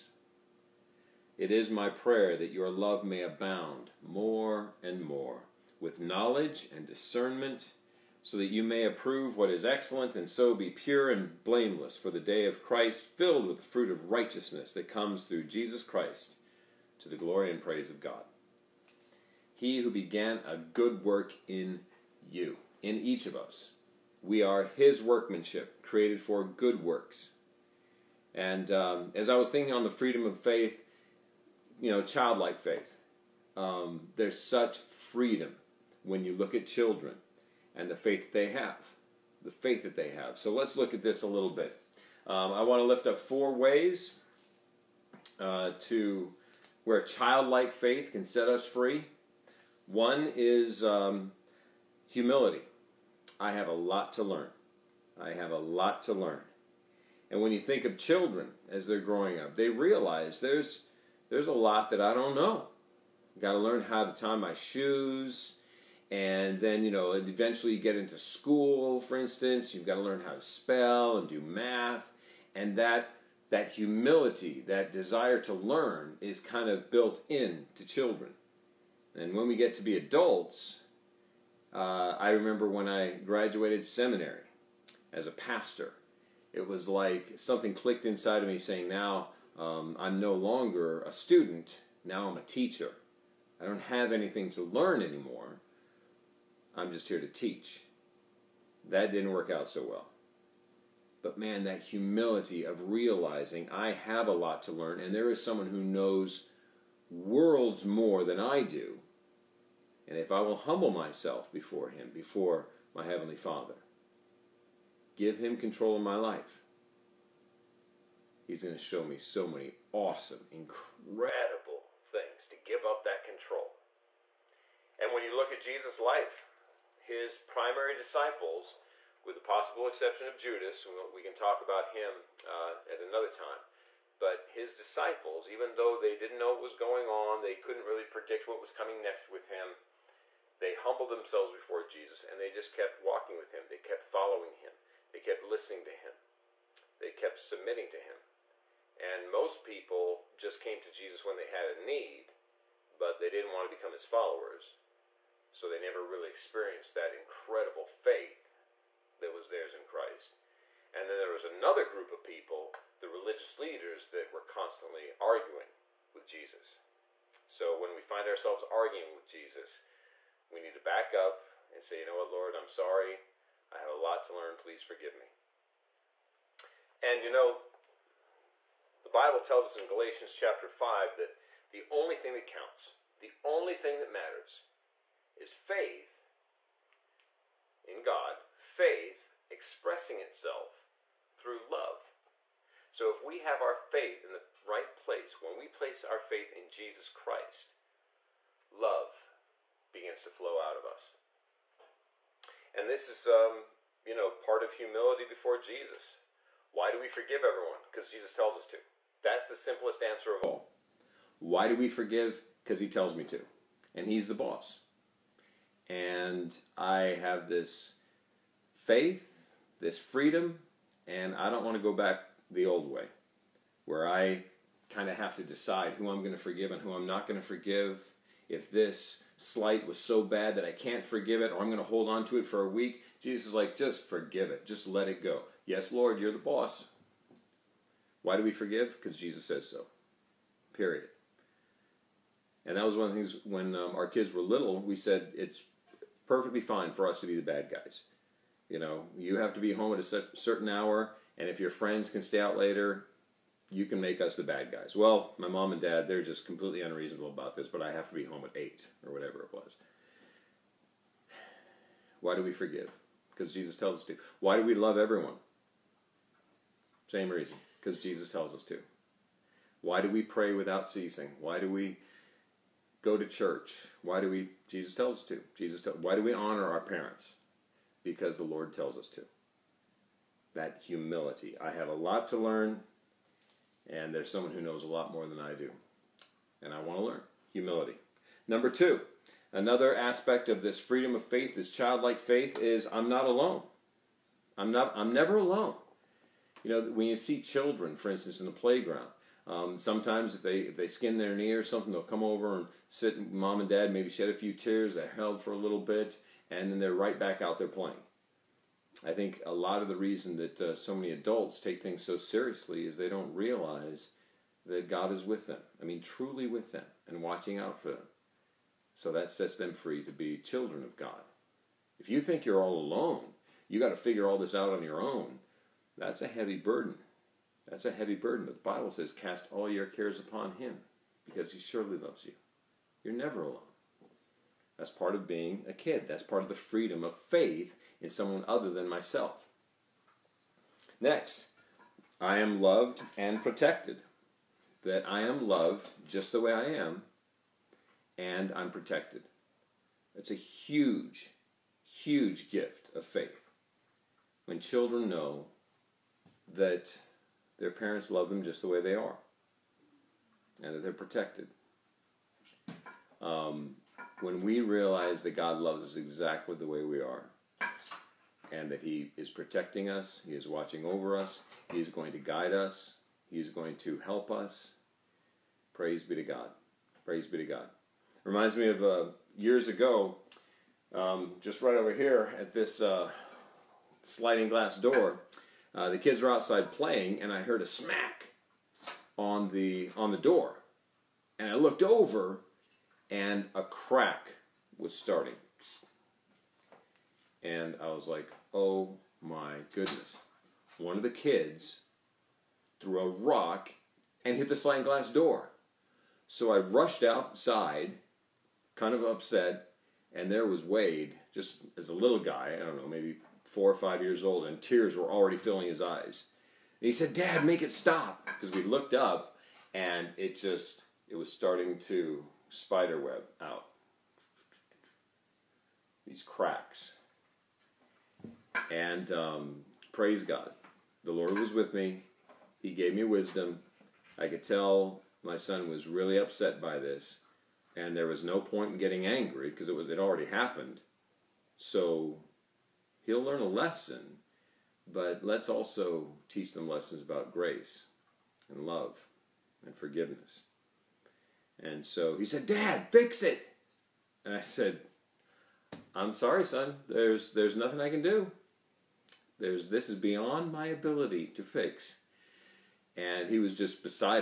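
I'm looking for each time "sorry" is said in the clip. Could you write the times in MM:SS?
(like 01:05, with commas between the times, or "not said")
02:52, 07:36.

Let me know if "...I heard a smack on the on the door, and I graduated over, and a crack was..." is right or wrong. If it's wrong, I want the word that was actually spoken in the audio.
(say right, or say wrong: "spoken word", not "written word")
wrong: "looked", not "graduated".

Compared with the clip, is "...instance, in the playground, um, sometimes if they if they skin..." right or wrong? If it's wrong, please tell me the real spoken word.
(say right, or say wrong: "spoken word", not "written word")
right.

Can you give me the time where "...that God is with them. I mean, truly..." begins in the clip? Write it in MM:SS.
05:14.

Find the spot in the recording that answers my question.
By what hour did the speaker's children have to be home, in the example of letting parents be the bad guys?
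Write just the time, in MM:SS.
04:18.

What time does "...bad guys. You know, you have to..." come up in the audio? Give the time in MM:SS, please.
04:07.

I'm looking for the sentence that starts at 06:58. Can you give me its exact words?
Because we looked up, and it just, it was starting to spiderweb out.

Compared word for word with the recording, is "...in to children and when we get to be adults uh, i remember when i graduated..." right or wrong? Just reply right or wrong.
right.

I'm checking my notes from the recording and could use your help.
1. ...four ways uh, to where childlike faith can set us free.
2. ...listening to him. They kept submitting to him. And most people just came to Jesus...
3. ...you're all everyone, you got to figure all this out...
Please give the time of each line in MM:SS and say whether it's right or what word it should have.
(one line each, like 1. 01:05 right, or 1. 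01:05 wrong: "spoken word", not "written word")
1. 00:43 right
2. 02:25 right
3. 05:22 wrong: "alone", not "everyone".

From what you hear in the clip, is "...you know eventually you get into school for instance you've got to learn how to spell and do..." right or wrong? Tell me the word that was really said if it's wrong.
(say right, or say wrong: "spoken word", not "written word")
right.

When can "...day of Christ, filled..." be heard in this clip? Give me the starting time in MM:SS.
00:12.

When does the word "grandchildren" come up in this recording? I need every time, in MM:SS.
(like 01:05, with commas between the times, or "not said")
not said.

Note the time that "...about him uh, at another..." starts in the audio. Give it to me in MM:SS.
02:11.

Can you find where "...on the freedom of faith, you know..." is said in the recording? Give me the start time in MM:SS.
00:29.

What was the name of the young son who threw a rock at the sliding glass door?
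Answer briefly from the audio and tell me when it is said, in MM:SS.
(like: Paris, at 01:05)
Wade, at 06:50.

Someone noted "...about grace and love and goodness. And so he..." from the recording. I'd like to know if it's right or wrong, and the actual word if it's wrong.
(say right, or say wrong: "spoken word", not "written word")
wrong: "forgiveness", not "goodness".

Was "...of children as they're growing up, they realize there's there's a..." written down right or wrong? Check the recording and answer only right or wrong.
right.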